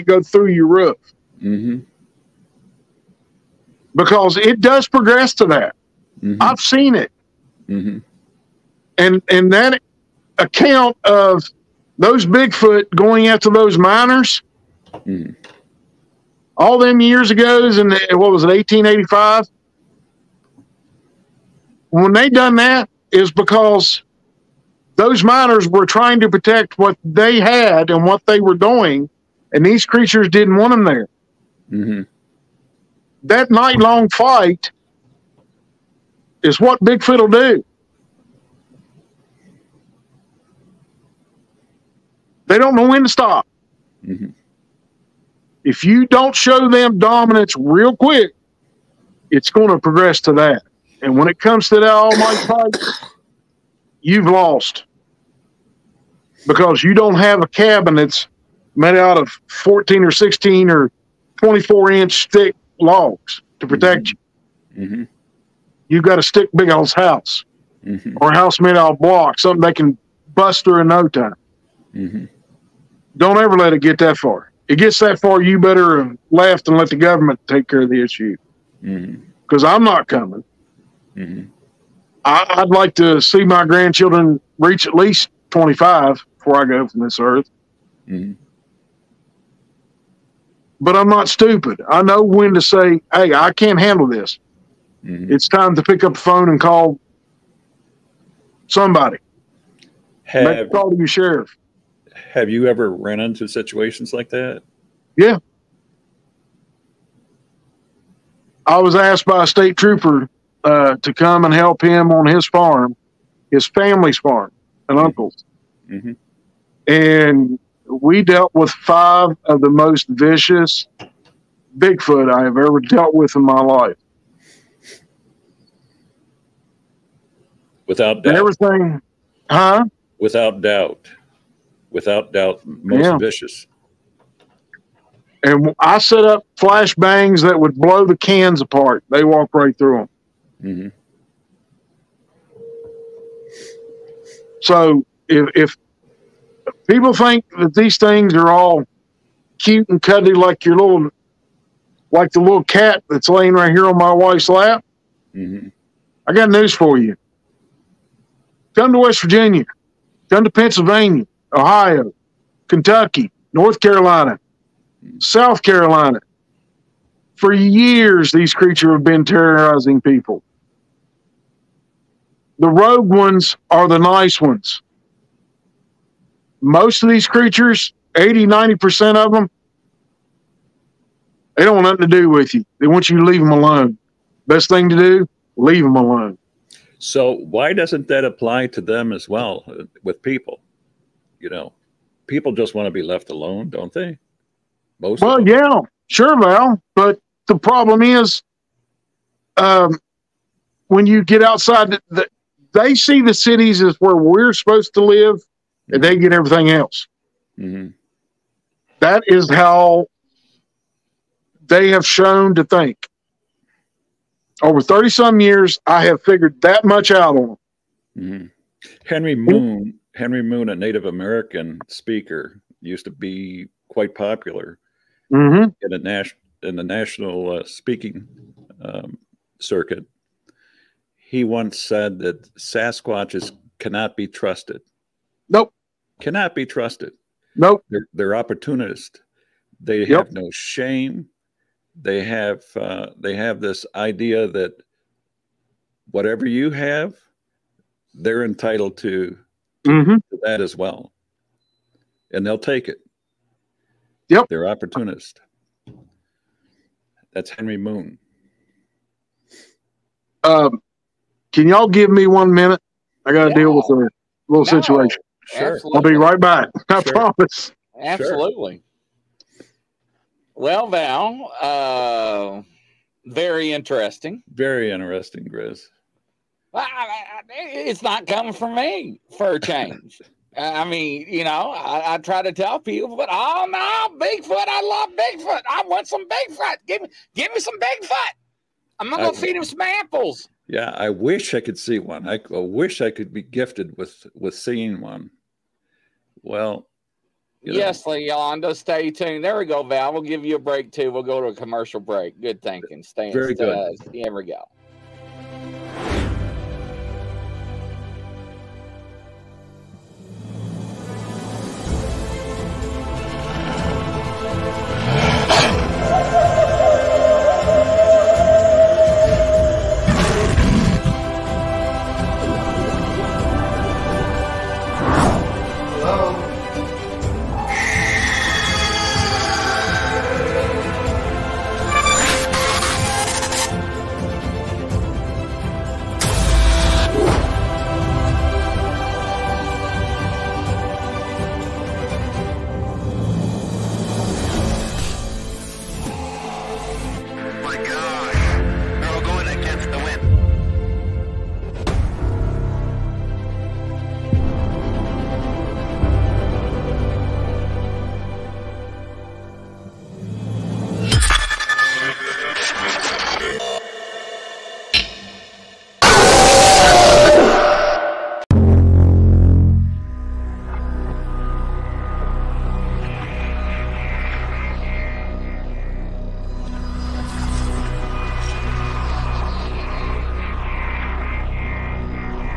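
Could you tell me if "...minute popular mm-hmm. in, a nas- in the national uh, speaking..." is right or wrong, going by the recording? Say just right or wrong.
wrong.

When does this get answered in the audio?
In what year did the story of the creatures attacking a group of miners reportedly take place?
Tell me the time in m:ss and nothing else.
0:18.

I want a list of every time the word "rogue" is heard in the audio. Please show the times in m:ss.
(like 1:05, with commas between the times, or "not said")
2:52.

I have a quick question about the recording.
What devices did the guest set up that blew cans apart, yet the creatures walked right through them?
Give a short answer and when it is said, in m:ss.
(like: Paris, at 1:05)
Flashbangs, at 2:16.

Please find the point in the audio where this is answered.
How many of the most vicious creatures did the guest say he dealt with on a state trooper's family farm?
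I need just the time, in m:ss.
1:58.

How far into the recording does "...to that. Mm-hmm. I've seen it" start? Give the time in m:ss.
0:05.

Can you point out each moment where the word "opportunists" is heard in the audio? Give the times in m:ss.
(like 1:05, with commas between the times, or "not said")
3:58, 4:14.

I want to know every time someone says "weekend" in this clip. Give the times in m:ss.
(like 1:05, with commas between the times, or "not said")
not said.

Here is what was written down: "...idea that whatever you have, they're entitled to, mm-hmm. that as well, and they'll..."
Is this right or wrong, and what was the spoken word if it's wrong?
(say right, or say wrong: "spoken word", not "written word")
right.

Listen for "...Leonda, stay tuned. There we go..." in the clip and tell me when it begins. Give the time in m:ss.
4:58.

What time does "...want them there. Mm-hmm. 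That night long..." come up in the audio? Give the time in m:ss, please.
0:30.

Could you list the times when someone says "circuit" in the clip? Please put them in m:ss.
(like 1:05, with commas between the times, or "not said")
3:49.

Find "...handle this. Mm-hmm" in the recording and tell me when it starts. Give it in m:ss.
1:33.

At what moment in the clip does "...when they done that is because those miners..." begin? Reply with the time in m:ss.
0:21.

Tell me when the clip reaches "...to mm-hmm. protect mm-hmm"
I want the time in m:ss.
1:03.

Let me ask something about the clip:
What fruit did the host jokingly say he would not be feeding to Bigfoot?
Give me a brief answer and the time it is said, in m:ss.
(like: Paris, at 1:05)
Apples, at 4:49.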